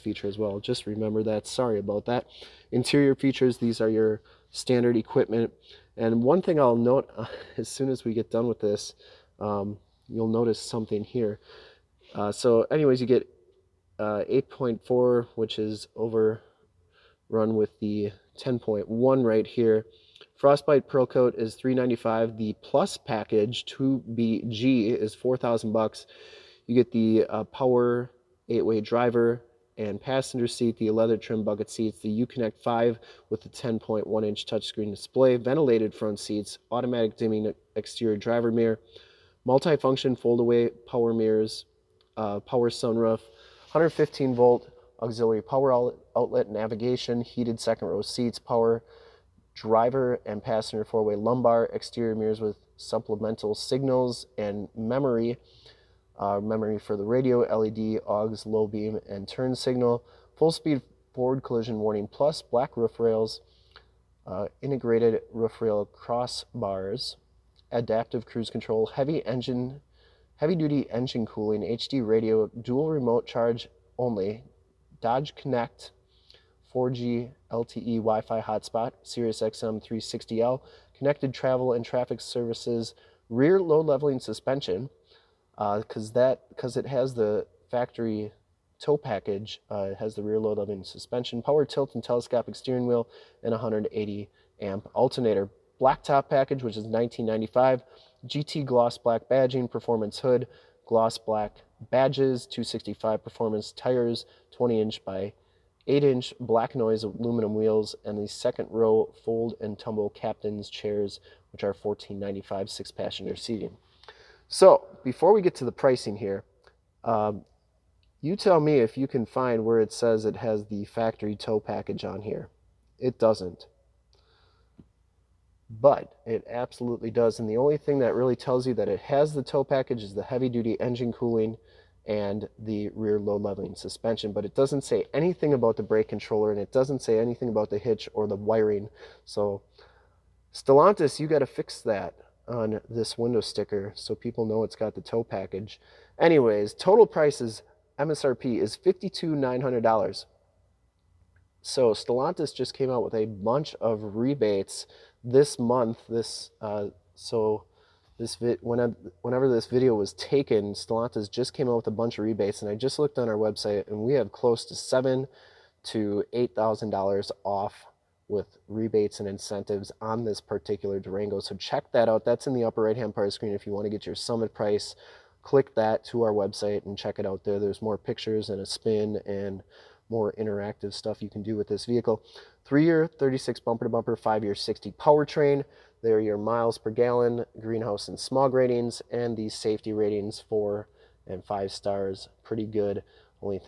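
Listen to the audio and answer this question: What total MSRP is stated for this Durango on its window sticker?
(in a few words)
$52,900.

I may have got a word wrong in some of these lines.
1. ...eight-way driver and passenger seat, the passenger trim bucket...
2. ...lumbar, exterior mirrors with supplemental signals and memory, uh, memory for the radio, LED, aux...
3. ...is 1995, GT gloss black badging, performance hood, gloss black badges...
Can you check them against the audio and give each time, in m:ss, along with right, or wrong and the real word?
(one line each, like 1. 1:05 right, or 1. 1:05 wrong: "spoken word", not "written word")
1. 0:28 wrong: "leather", not "passenger"
2. 0:51 right
3. 1:36 right.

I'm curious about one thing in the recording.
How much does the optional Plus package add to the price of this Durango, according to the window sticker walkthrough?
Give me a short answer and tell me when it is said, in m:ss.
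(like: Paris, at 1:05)
$4,000, at 0:25.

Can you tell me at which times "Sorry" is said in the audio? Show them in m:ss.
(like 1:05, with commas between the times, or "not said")
0:01.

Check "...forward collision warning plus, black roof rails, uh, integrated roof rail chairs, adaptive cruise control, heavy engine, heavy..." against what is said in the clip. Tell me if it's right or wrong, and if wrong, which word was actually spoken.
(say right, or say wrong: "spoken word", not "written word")
wrong: "crossbars", not "chairs".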